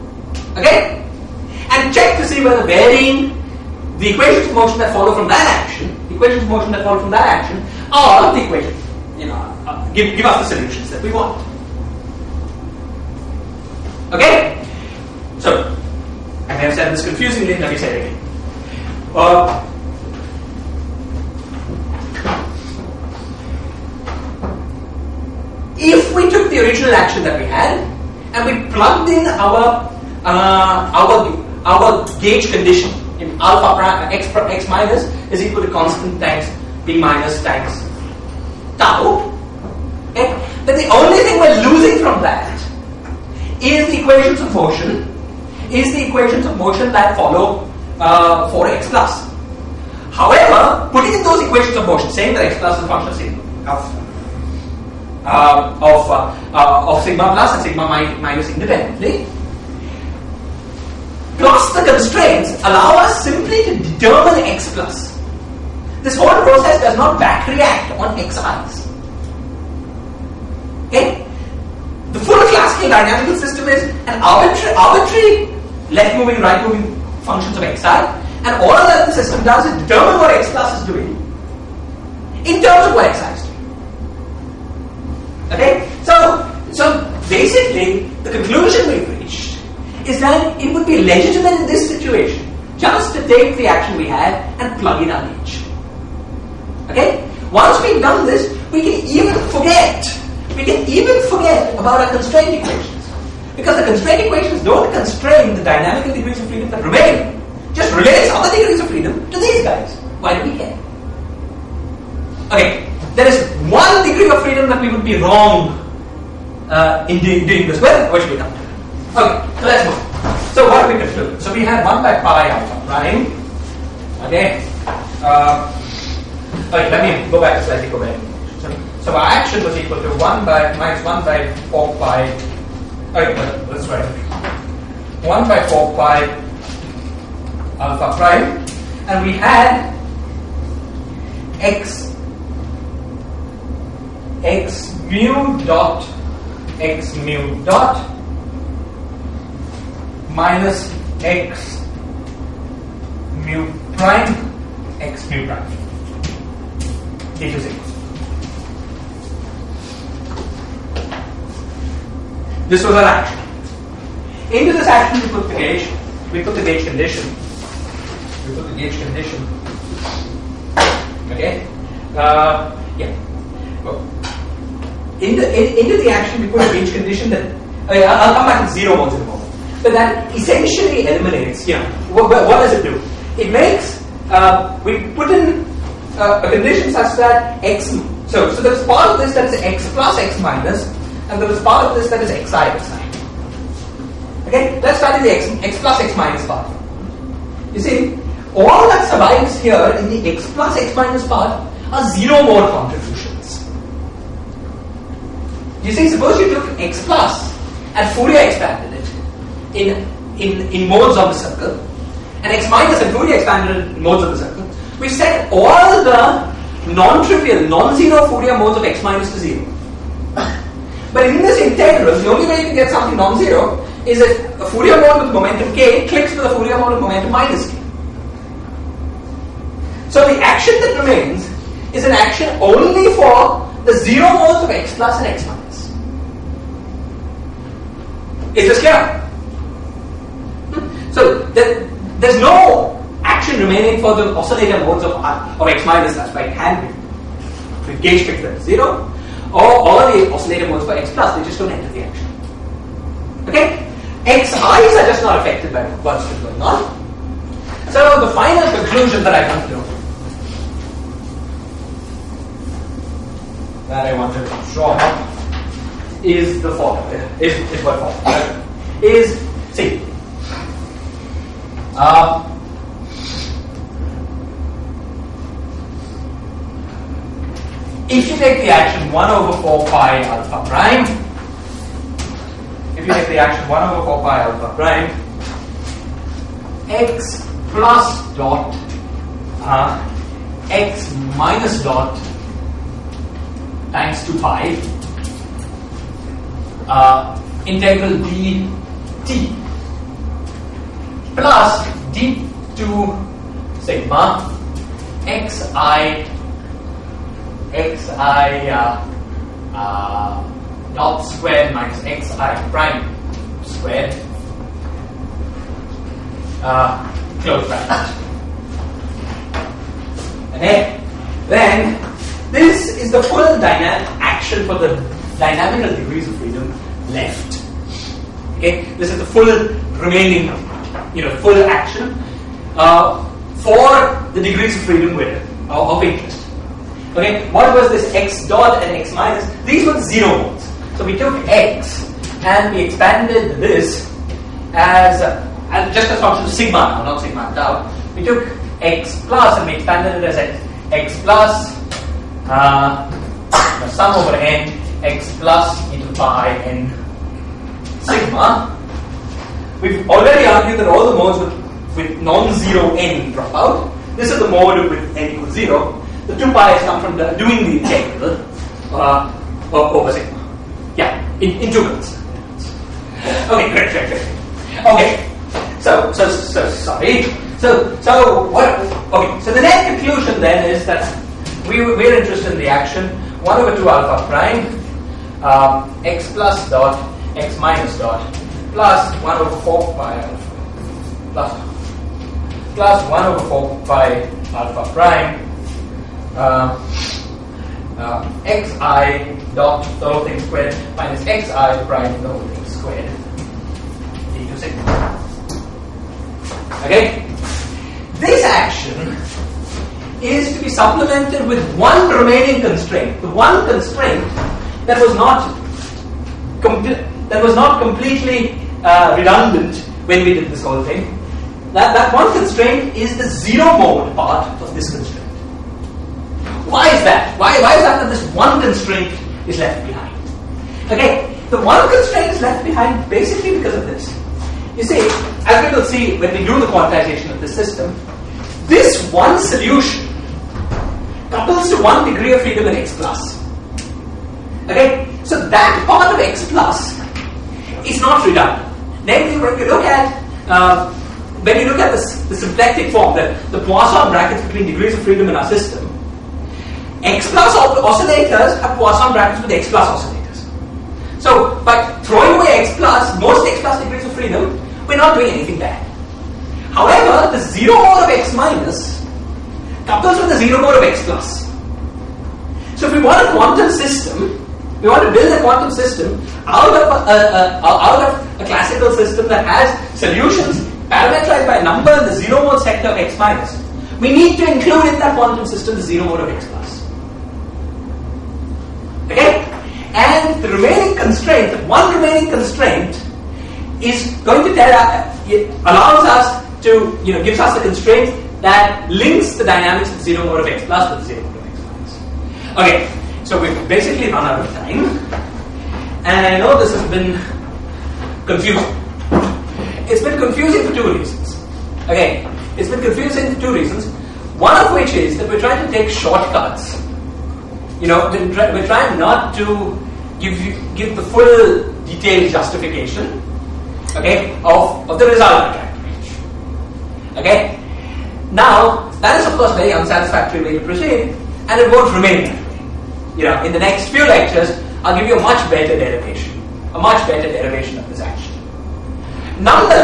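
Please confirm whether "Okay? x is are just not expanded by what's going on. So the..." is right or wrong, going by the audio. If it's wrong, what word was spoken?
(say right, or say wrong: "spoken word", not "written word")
wrong: "affected", not "expanded".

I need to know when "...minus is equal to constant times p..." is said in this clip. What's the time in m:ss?
0:34.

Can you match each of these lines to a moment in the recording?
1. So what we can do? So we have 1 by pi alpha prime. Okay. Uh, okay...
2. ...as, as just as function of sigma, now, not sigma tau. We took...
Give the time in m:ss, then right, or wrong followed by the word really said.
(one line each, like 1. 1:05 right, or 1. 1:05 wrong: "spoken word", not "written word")
1. 2:00 right
2. 5:44 right.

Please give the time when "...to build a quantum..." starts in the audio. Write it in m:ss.
7:55.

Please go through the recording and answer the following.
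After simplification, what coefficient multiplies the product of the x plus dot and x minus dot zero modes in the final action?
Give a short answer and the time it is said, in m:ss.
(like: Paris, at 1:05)
1 over 2 alpha prime, at 6:23.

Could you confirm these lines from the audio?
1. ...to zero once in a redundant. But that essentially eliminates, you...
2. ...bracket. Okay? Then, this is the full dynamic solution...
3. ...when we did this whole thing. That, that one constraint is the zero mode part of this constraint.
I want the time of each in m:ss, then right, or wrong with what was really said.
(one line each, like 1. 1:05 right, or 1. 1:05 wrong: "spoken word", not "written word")
1. 2:58 wrong: "moment", not "redundant"
2. 5:17 wrong: "action", not "solution"
3. 7:00 right.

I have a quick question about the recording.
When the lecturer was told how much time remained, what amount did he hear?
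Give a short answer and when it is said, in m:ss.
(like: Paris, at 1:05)
two minutes, at 6:11.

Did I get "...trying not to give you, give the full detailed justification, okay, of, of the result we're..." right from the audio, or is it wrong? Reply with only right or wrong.
right.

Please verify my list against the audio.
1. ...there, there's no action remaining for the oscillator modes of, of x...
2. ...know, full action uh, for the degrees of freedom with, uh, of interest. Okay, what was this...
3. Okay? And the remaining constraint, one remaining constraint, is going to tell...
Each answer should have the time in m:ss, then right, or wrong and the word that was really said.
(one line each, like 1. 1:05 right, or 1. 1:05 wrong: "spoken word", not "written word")
1. 4:01 right
2. 5:31 right
3. 8:09 right.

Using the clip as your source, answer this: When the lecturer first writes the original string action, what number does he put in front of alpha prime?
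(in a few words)
1 by 4 pi.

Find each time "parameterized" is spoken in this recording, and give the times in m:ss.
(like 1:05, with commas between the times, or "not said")
8:00.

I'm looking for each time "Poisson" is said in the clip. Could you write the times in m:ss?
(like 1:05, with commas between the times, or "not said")
7:33, 7:38.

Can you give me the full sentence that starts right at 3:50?
So the action that remains is an action only for the zero modes of x plus and x minus.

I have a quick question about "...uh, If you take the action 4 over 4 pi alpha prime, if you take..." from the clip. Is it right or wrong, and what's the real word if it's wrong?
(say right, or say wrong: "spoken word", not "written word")
wrong: "1", not "4".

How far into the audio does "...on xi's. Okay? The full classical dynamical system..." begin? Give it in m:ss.
1:07.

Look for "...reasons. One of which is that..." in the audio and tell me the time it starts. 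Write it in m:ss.
8:33.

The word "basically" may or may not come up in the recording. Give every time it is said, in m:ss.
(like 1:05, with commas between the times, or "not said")
1:27, 7:13, 8:23.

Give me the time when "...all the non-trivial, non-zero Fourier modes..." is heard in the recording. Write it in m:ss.
3:35.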